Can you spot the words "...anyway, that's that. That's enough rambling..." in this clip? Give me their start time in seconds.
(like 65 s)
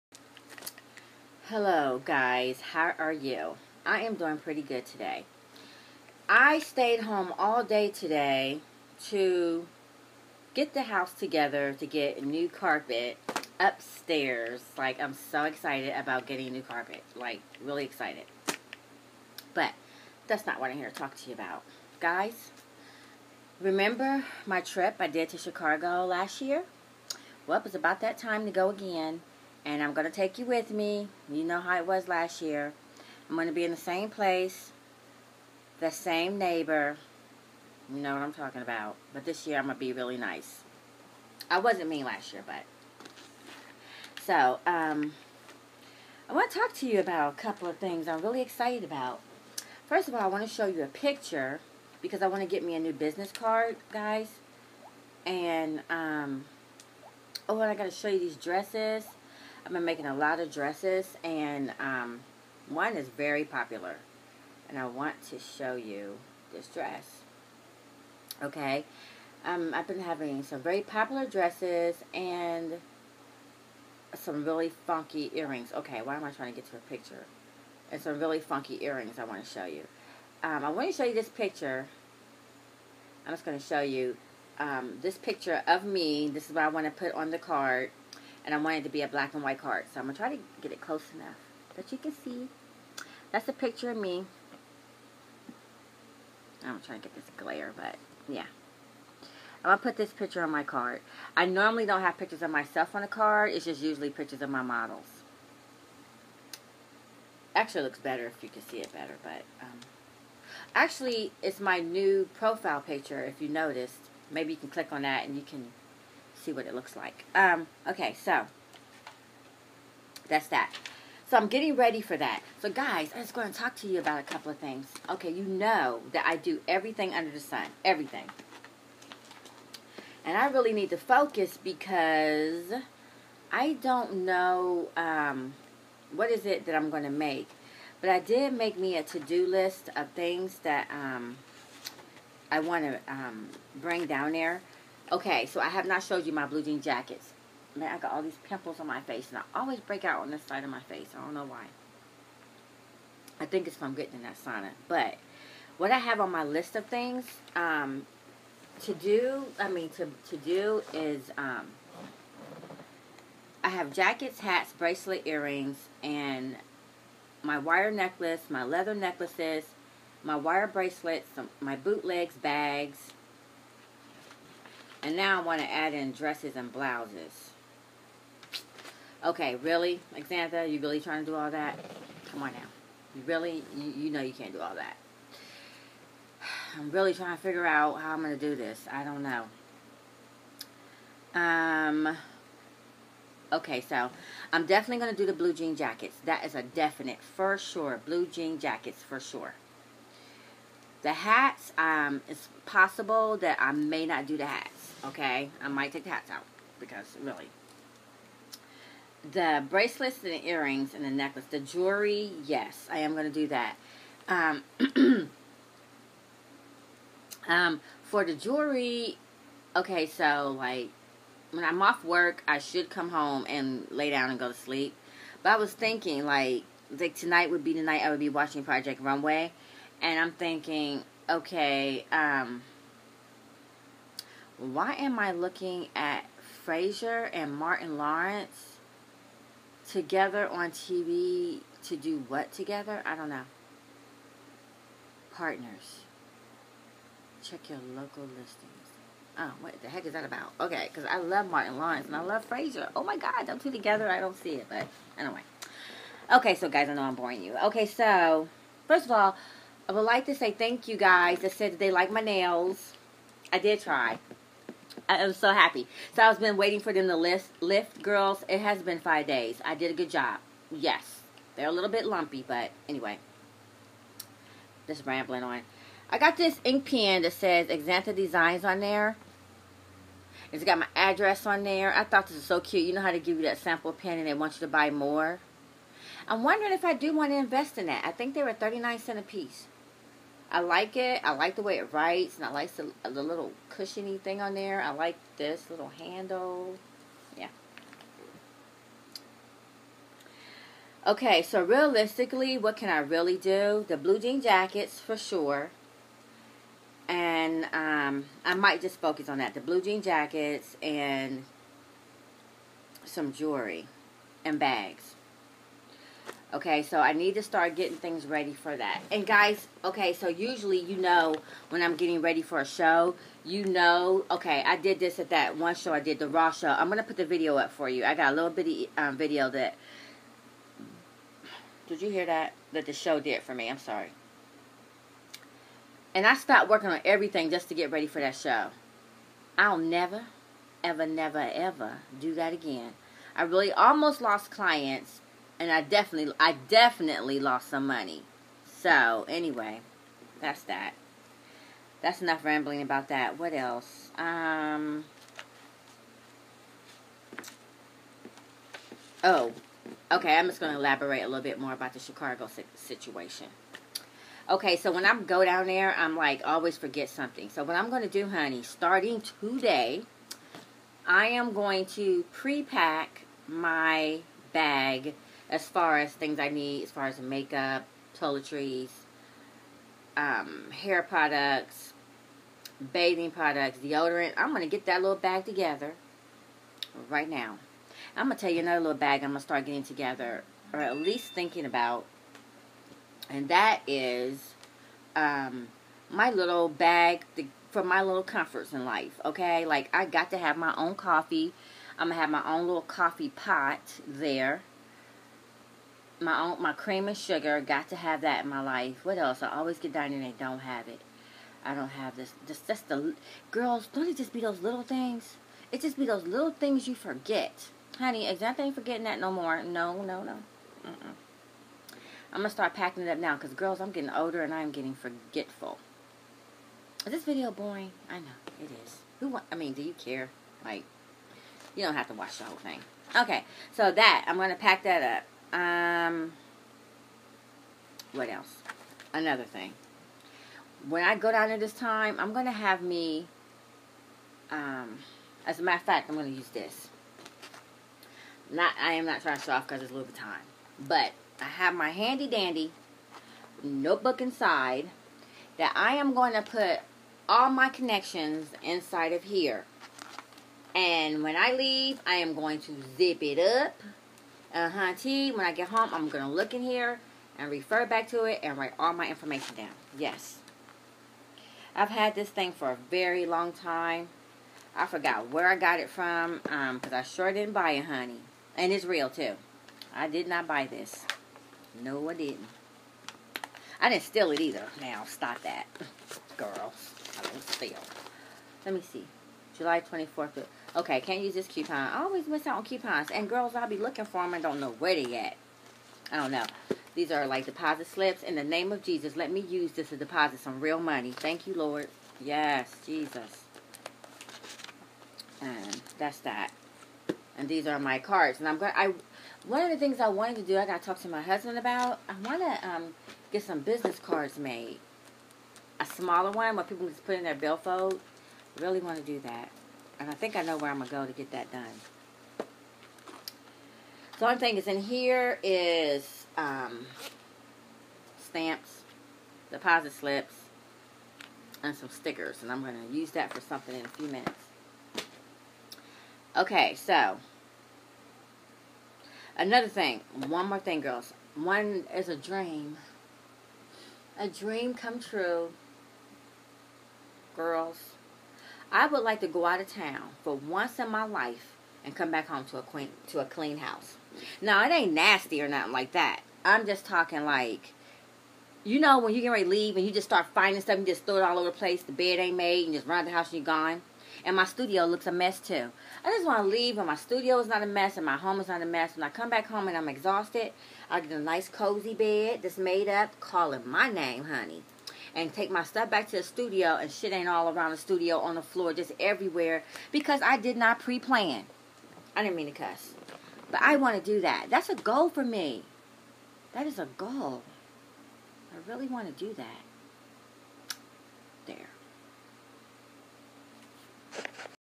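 349 s.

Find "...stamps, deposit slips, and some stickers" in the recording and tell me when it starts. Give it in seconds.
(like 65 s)
528 s.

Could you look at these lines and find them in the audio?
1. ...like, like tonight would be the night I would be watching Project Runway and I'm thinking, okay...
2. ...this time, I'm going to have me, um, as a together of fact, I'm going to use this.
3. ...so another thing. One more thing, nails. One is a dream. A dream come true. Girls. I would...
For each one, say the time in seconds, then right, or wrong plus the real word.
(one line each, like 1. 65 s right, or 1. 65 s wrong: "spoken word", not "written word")
1. 226 s right
2. 441 s wrong: "matter", not "together"
3. 536 s wrong: "girls", not "nails".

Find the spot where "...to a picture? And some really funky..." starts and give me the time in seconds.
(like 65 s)
76 s.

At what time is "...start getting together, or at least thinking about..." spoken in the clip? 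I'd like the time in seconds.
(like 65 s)
389 s.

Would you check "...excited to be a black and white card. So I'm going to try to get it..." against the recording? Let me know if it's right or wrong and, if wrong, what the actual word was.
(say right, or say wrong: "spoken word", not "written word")
wrong: "wanted", not "excited".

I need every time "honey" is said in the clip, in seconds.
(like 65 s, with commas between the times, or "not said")
368 s, 417 s, 477 s, 574 s.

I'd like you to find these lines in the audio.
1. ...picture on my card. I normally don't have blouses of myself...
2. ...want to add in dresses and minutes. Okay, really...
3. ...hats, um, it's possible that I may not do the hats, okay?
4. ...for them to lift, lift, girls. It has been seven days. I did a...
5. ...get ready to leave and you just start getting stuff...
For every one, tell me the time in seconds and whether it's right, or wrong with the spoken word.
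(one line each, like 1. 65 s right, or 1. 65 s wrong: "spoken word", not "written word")
1. 100 s wrong: "pictures", not "blouses"
2. 175 s wrong: "blouses", not "minutes"
3. 201 s right
4. 266 s wrong: "five", not "seven"
5. 559 s wrong: "finding", not "getting".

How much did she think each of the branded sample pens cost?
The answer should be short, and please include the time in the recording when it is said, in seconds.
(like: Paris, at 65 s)
39 cents, at 288 s.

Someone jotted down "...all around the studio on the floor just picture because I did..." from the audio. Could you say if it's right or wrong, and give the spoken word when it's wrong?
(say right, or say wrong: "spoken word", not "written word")
wrong: "everywhere", not "picture".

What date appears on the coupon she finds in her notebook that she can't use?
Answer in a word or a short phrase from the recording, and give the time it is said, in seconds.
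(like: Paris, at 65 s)
July 24th, at 489 s.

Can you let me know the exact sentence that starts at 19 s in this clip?
But that's not what I'm here to talk to you about.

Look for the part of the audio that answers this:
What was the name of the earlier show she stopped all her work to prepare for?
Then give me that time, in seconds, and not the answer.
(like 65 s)
326 s.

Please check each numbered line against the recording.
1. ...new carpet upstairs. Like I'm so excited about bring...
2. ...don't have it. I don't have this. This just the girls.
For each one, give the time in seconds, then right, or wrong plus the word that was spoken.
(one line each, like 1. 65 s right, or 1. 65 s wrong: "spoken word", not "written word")
1. 12 s wrong: "getting", not "bring"
2. 410 s right.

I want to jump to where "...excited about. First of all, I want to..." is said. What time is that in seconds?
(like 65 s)
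48 s.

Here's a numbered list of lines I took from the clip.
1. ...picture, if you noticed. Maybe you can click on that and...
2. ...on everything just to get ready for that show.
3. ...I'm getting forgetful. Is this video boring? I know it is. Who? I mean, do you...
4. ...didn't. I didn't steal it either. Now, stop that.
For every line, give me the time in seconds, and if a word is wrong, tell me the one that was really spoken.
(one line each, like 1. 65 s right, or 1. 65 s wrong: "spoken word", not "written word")
1. 112 s right
2. 336 s right
3. 424 s right
4. 482 s right.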